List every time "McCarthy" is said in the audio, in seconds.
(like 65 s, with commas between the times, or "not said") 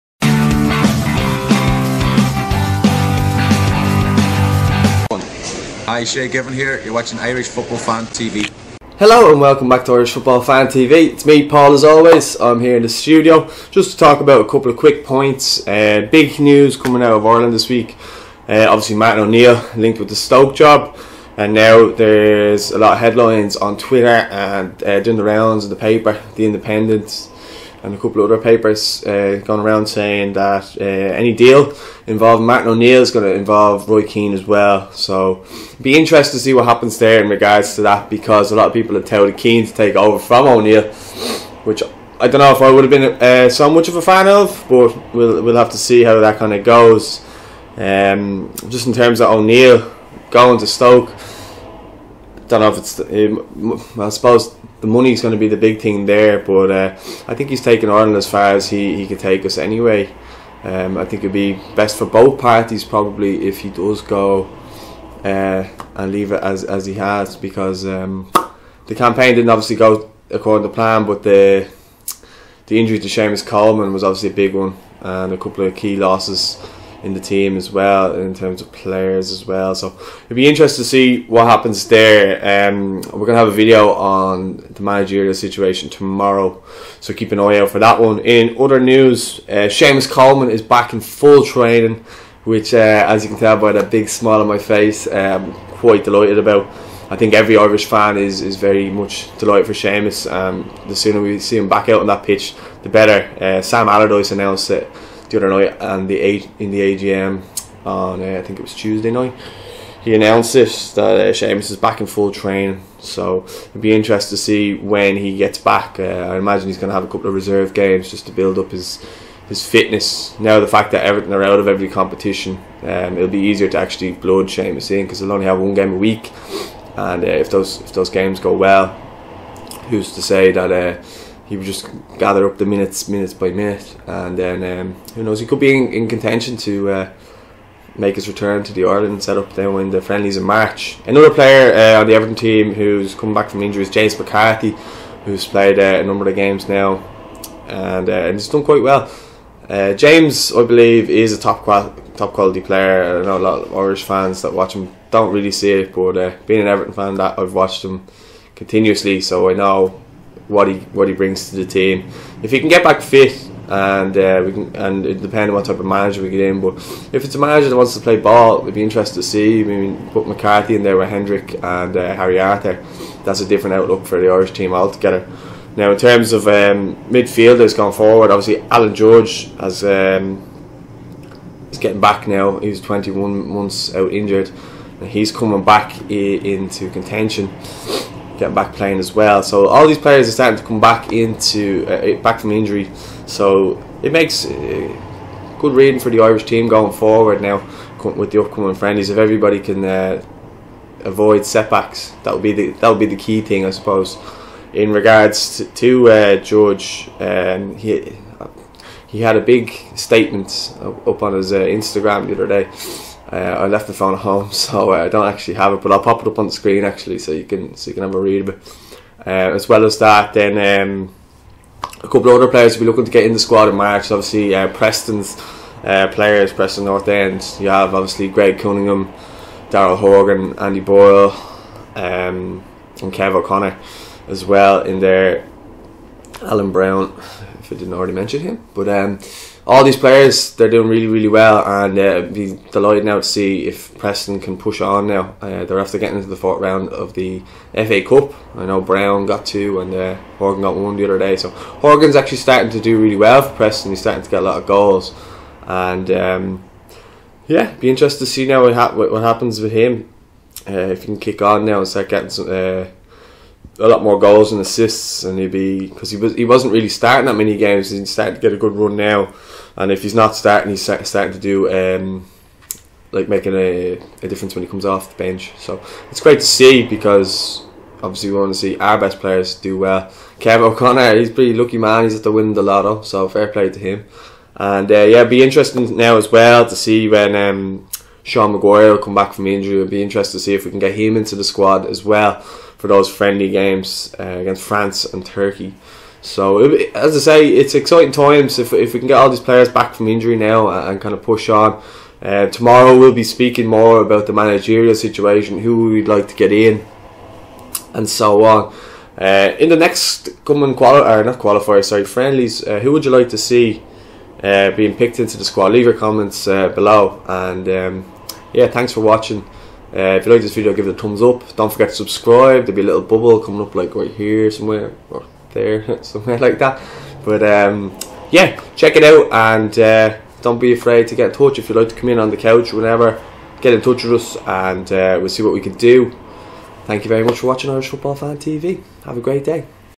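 144 s, 170 s.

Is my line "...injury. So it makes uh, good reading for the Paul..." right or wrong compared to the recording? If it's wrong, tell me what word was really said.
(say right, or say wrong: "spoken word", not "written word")
wrong: "Irish", not "Paul".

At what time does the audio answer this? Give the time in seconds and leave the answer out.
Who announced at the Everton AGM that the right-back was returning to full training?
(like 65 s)
103 s.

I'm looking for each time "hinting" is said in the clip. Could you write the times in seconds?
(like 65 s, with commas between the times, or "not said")
not said.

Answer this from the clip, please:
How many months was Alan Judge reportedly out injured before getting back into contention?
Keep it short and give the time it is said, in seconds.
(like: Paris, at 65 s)
21, at 182 s.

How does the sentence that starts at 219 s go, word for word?
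Uh, as well as that, then um, a couple of other players will be looking to get in the squad in March.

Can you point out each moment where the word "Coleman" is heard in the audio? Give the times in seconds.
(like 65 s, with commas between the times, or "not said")
73 s, 90 s.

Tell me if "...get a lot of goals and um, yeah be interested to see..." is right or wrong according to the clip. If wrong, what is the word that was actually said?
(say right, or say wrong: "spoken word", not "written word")
right.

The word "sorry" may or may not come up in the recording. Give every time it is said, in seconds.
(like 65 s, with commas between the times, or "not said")
311 s.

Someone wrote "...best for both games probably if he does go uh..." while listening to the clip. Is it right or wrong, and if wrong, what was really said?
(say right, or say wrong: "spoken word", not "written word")
wrong: "parties", not "games".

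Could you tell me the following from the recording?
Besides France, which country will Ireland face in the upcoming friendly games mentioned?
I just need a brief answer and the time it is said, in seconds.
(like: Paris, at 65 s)
Turkey, at 295 s.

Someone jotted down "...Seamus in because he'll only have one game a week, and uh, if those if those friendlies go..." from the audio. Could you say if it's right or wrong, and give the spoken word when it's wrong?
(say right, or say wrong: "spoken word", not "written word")
wrong: "games", not "friendlies".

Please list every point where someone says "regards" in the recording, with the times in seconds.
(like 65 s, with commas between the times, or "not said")
37 s, 204 s.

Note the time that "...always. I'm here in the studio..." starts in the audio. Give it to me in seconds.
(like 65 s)
11 s.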